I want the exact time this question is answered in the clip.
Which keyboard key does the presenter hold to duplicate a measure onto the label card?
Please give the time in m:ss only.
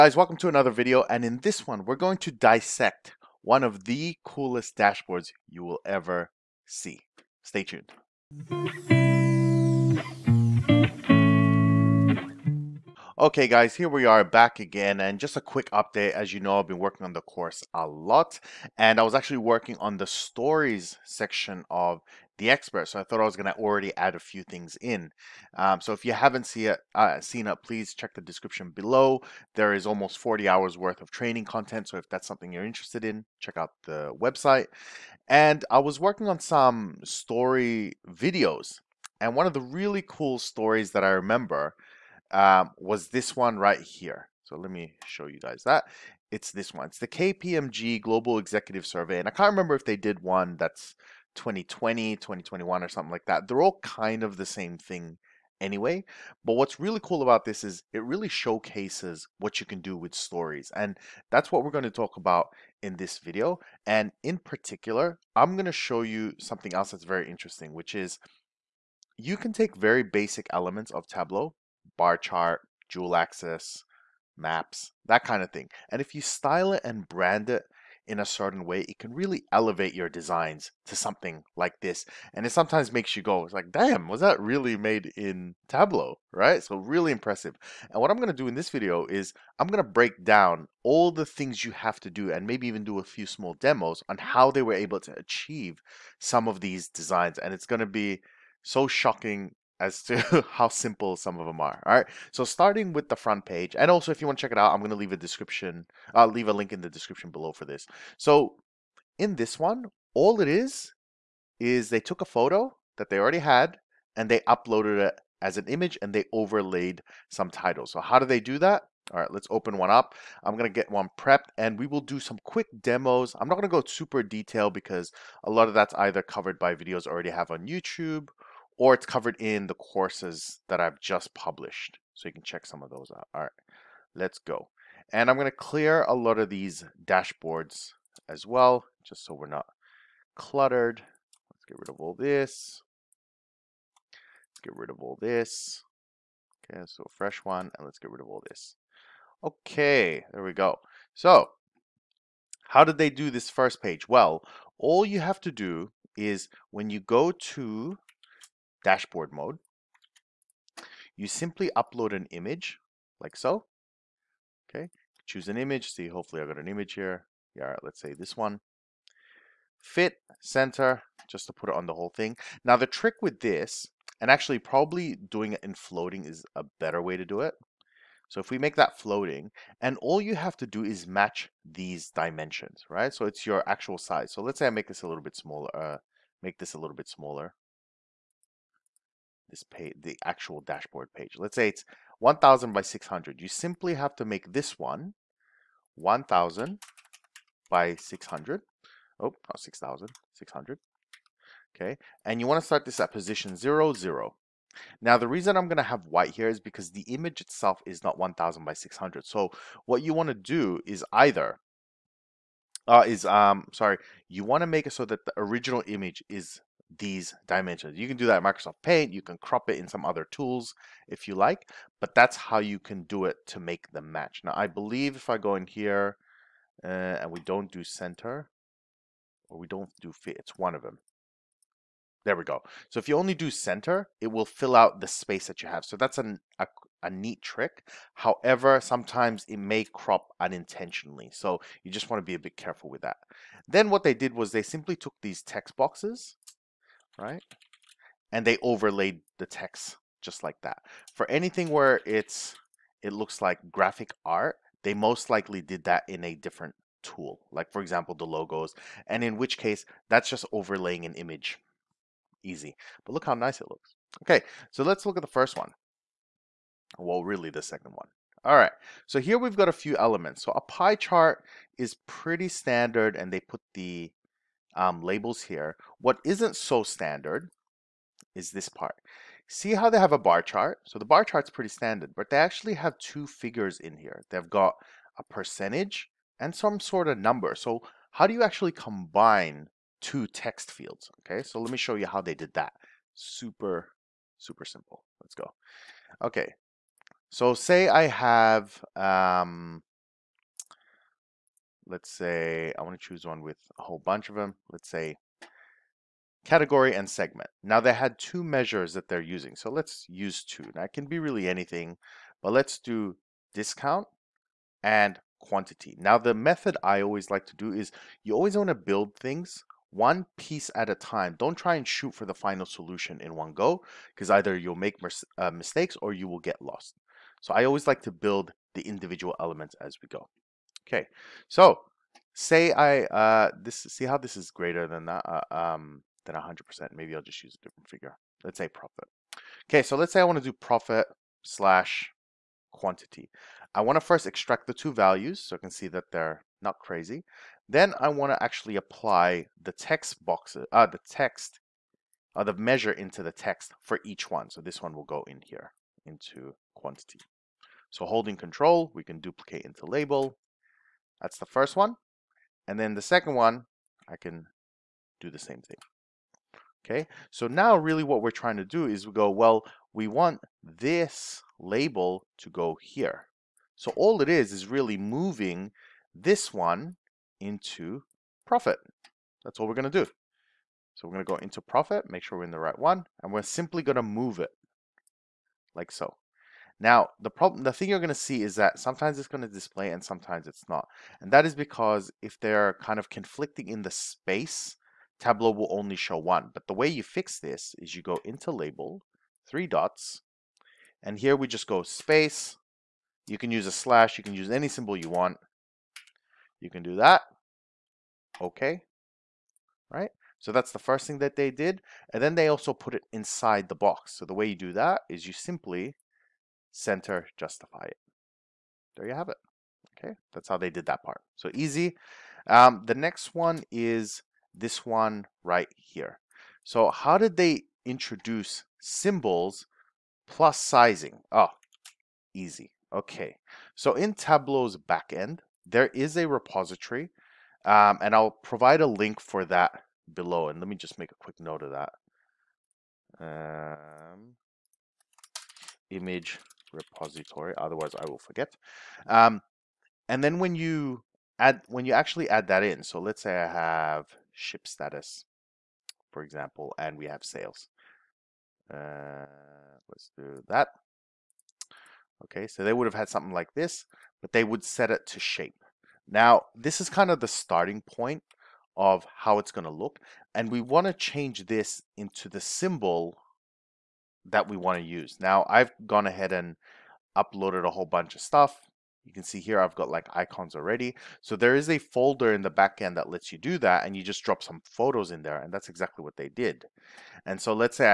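5:58.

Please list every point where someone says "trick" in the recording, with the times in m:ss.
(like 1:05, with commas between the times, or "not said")
2:52, 3:57.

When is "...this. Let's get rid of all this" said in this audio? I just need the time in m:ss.
2:22.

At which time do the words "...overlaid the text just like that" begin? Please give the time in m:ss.
4:08.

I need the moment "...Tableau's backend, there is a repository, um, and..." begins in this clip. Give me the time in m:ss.
7:14.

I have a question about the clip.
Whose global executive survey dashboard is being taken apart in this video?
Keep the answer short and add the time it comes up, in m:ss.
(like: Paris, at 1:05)
KPMG, at 0:47.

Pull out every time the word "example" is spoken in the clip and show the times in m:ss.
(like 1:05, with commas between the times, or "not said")
4:17, 7:36.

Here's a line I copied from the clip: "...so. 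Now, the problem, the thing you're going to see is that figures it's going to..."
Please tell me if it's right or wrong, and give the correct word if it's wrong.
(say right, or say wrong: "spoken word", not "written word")
wrong: "sometimes", not "figures".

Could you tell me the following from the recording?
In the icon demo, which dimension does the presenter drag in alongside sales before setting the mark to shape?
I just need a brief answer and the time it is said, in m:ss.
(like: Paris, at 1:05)
ship status, at 7:34.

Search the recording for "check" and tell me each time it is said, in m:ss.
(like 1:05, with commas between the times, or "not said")
0:27, 0:33, 1:44, 2:12.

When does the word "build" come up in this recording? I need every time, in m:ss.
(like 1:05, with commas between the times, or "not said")
5:18, 5:28.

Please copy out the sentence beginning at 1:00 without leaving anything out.
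And that's what we're going to talk about in this video.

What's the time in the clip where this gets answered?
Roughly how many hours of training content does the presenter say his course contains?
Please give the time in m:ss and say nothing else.
0:30.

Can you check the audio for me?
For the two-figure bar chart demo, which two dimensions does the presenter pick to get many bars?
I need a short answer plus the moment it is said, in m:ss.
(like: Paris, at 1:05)
category and segment, at 5:06.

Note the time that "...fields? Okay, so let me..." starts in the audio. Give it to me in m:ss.
4:50.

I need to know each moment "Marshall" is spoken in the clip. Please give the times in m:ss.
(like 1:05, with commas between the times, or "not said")
not said.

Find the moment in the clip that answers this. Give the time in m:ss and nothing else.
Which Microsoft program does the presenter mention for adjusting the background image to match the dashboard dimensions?
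3:38.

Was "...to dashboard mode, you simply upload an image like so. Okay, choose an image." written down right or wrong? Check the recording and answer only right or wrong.
right.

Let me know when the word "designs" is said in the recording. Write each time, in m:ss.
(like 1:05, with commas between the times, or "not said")
1:20, 1:36.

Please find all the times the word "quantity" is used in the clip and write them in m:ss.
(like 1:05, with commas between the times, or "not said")
5:15, 5:42, 5:56.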